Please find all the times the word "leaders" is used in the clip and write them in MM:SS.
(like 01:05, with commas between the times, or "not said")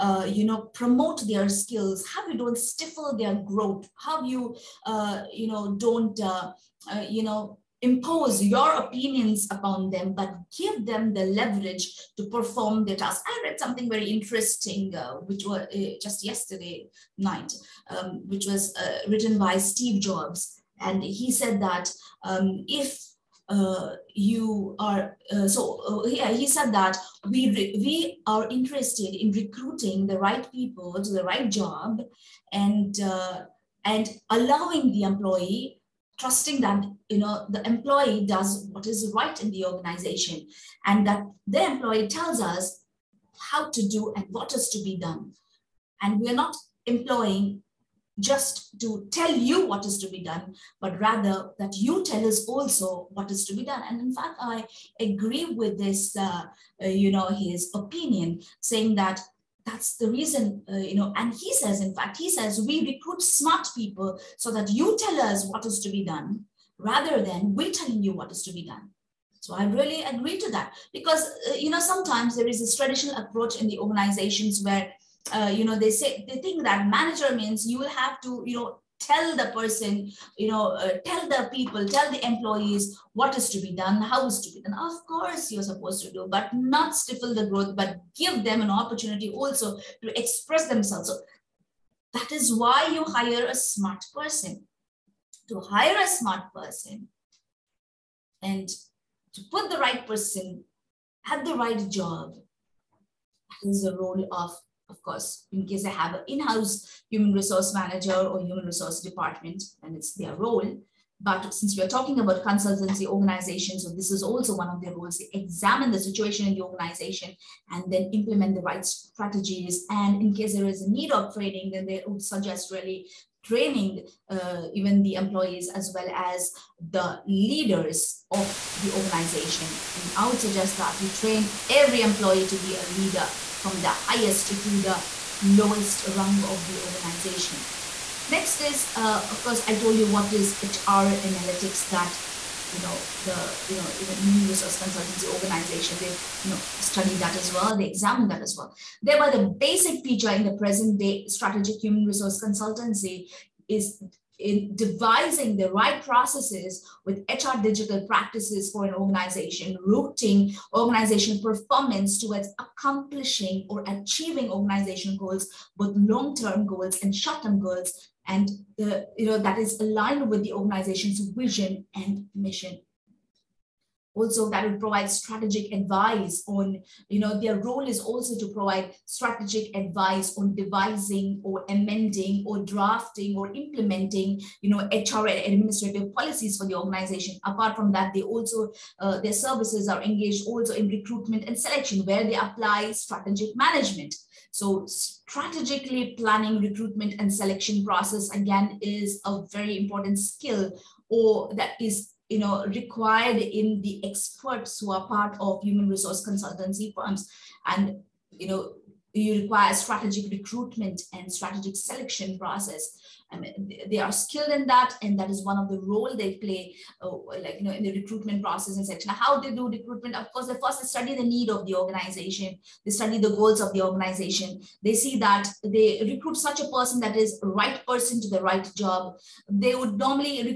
02:07, 02:12.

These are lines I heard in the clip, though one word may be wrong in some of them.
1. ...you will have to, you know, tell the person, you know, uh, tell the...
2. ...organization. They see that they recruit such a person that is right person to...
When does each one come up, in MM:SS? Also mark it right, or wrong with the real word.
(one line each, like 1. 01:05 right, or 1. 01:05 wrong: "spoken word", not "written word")
1. 01:17 right
2. 03:43 right.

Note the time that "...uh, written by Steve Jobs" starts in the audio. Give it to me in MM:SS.
00:18.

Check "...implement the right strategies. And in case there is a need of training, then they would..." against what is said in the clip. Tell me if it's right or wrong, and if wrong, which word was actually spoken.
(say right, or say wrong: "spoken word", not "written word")
right.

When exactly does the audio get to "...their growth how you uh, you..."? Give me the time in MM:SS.
00:03.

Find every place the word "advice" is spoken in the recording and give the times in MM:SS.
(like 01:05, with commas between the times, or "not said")
02:55, 02:59.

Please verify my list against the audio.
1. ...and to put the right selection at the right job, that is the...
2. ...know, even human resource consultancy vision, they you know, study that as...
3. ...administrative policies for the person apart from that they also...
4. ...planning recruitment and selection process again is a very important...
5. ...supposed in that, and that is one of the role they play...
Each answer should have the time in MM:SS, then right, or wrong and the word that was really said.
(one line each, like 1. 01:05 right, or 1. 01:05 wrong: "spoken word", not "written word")
1. 01:38 wrong: "person", not "selection"
2. 02:23 wrong: "organization", not "vision"
3. 03:05 wrong: "organization", not "person"
4. 03:16 right
5. 03:34 wrong: "skilled", not "supposed".